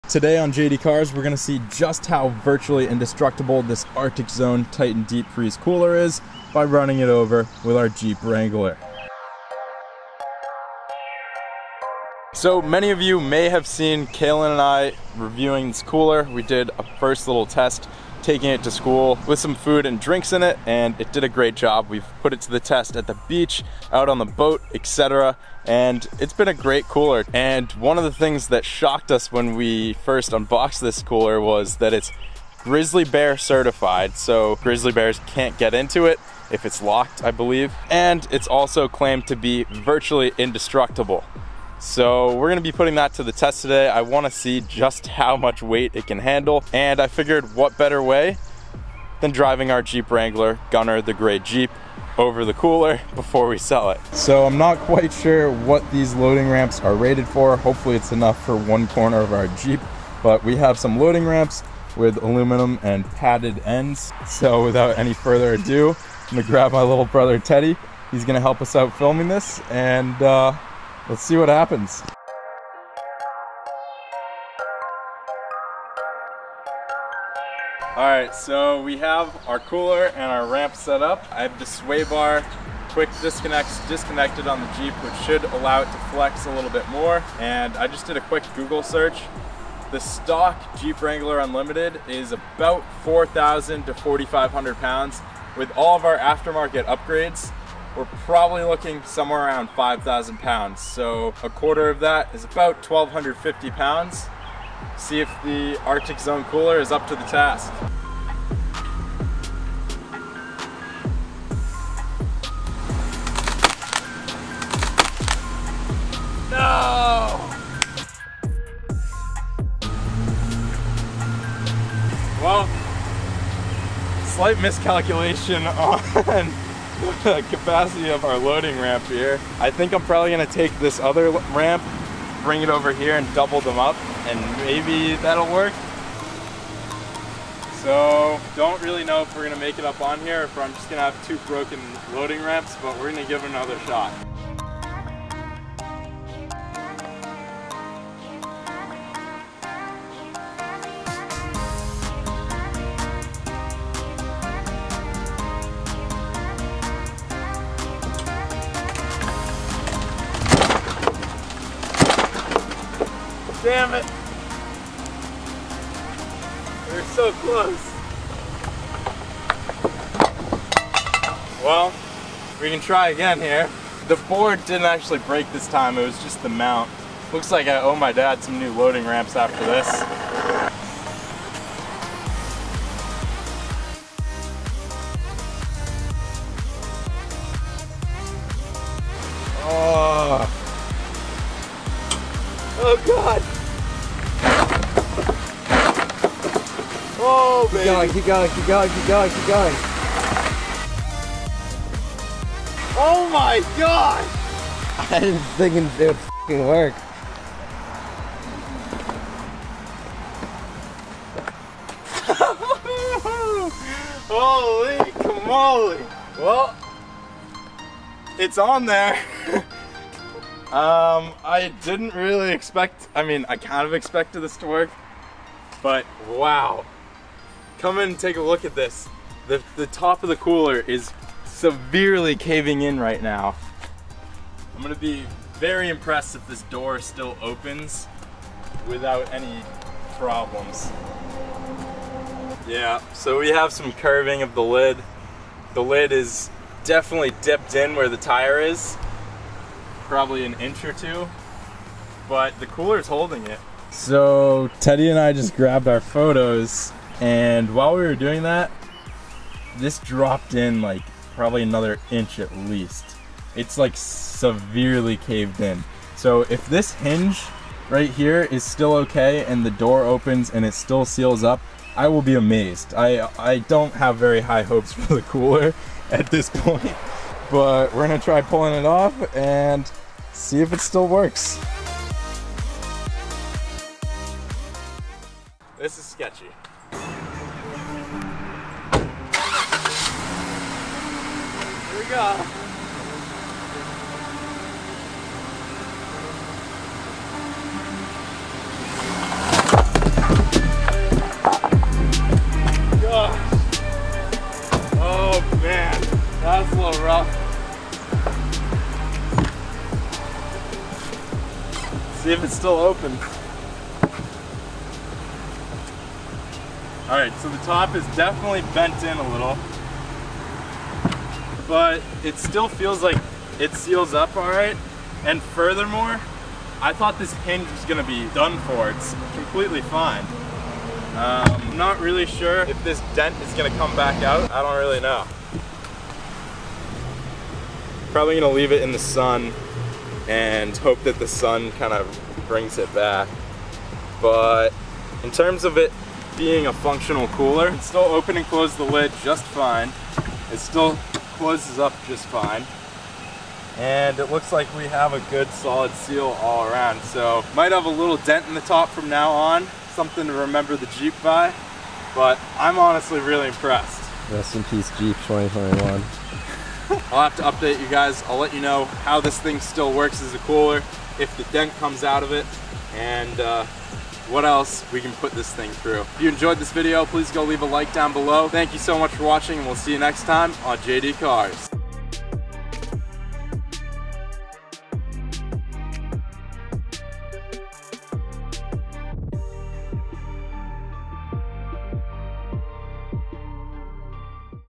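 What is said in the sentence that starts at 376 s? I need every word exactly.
If you enjoyed this video, please go leave a like down below.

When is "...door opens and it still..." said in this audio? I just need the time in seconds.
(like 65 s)
269 s.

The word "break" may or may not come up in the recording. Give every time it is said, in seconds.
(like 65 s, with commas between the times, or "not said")
175 s.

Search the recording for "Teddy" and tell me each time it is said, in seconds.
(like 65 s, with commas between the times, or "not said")
67 s, 254 s.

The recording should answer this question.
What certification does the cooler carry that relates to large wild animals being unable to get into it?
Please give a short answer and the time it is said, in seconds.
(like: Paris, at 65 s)
Grizzly bear certified, at 32 s.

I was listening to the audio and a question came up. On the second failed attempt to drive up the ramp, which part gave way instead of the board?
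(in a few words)
The mount.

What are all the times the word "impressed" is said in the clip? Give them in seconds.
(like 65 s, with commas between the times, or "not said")
235 s, 363 s.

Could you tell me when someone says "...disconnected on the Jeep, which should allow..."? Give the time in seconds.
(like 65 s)
83 s.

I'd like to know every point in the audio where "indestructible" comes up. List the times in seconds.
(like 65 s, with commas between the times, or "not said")
2 s, 40 s.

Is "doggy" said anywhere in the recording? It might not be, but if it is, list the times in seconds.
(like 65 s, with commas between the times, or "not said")
not said.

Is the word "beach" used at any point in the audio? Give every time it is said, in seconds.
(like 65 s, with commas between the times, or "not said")
23 s.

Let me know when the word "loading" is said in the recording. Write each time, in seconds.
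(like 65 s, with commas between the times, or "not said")
56 s, 60 s, 128 s, 142 s, 178 s.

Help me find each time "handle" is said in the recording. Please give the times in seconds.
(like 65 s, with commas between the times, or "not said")
46 s.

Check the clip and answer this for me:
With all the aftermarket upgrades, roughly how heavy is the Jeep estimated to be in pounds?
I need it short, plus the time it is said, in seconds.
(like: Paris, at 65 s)
5,000 pounds, at 99 s.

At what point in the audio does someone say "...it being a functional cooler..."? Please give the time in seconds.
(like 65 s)
345 s.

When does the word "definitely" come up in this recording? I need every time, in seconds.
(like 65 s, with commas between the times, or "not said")
246 s, 318 s.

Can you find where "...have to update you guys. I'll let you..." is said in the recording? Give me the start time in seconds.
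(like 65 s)
367 s.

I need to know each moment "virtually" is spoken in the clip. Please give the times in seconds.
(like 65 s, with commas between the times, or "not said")
2 s, 39 s.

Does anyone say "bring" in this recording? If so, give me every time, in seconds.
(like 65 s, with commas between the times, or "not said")
132 s, 342 s.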